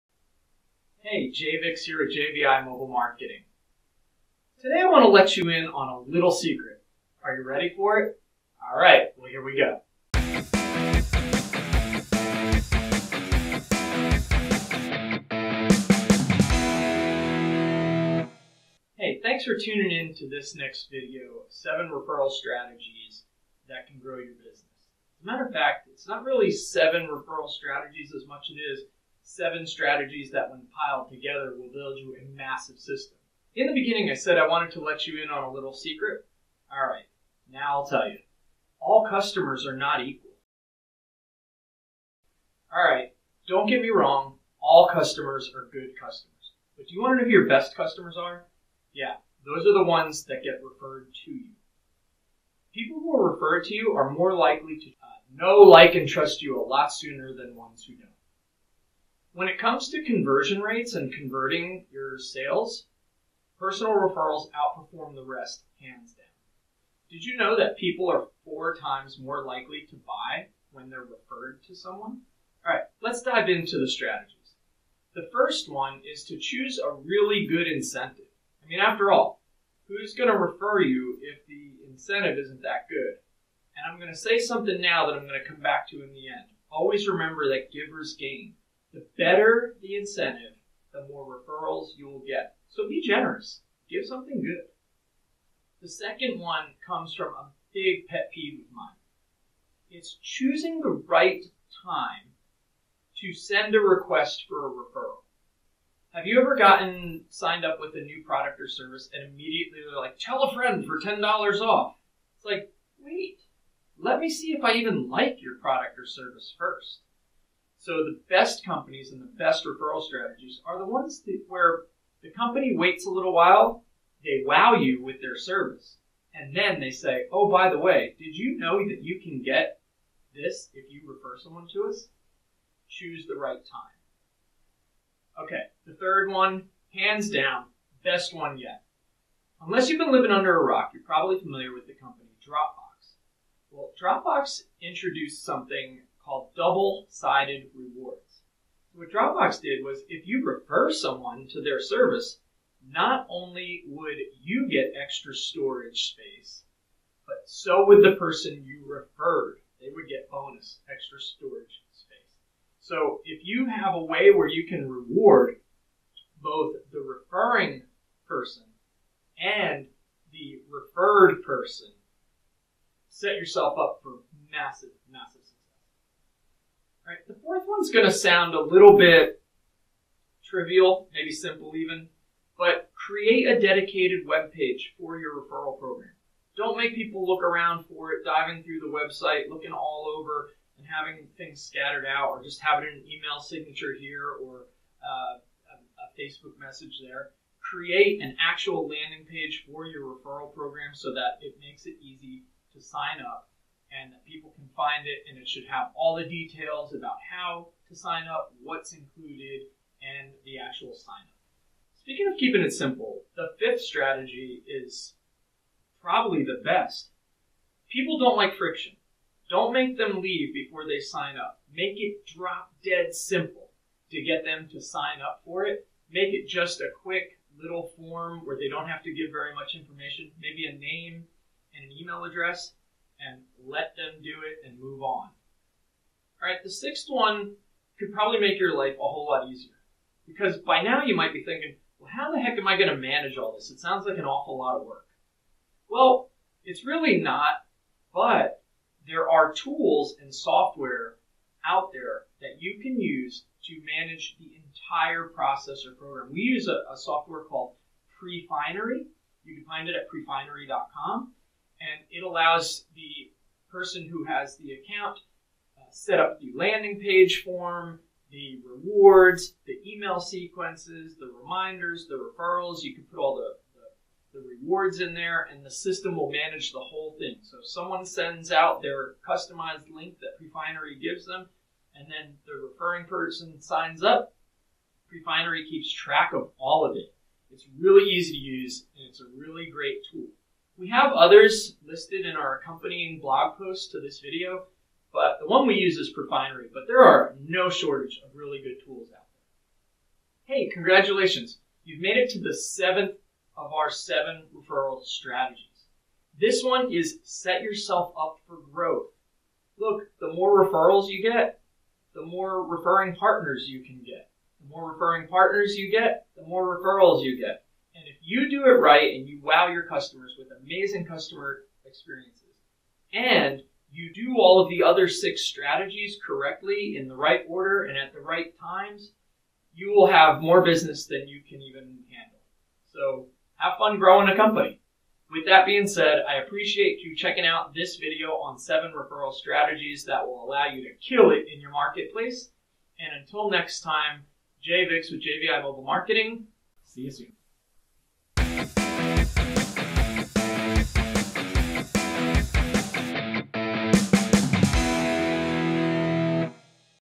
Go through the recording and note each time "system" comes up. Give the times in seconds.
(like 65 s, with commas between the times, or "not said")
32 s, 275 s.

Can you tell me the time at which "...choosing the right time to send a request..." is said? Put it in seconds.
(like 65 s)
100 s.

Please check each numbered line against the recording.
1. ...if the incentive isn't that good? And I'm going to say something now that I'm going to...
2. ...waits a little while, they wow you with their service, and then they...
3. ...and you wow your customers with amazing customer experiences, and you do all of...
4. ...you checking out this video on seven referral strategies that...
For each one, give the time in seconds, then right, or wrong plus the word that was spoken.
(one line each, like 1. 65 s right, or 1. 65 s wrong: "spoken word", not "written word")
1. 81 s right
2. 122 s right
3. 319 s right
4. 337 s right.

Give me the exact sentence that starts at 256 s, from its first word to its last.
We use a, a software called Prefinery.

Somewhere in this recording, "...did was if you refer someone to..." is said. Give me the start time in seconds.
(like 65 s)
149 s.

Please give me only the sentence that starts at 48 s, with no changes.
Yeah, those are the ones that get referred to you.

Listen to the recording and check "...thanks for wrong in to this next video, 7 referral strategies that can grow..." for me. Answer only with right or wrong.
wrong.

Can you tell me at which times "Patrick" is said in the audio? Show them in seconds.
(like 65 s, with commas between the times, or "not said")
not said.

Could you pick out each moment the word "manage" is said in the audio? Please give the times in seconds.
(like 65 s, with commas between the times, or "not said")
242 s, 253 s, 276 s.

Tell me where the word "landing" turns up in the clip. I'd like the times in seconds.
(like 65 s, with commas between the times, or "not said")
198 s, 266 s.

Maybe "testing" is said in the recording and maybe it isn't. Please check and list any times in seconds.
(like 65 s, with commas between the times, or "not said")
not said.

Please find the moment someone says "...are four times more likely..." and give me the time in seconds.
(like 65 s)
68 s.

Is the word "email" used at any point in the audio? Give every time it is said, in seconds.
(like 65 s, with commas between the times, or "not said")
193 s, 231 s, 269 s.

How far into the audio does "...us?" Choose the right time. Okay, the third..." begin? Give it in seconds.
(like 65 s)
131 s.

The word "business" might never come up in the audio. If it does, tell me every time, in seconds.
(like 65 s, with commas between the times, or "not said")
24 s, 330 s.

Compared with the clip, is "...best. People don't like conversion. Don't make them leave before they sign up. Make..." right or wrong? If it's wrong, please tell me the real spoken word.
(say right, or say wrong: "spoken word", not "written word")
wrong: "friction", not "conversion".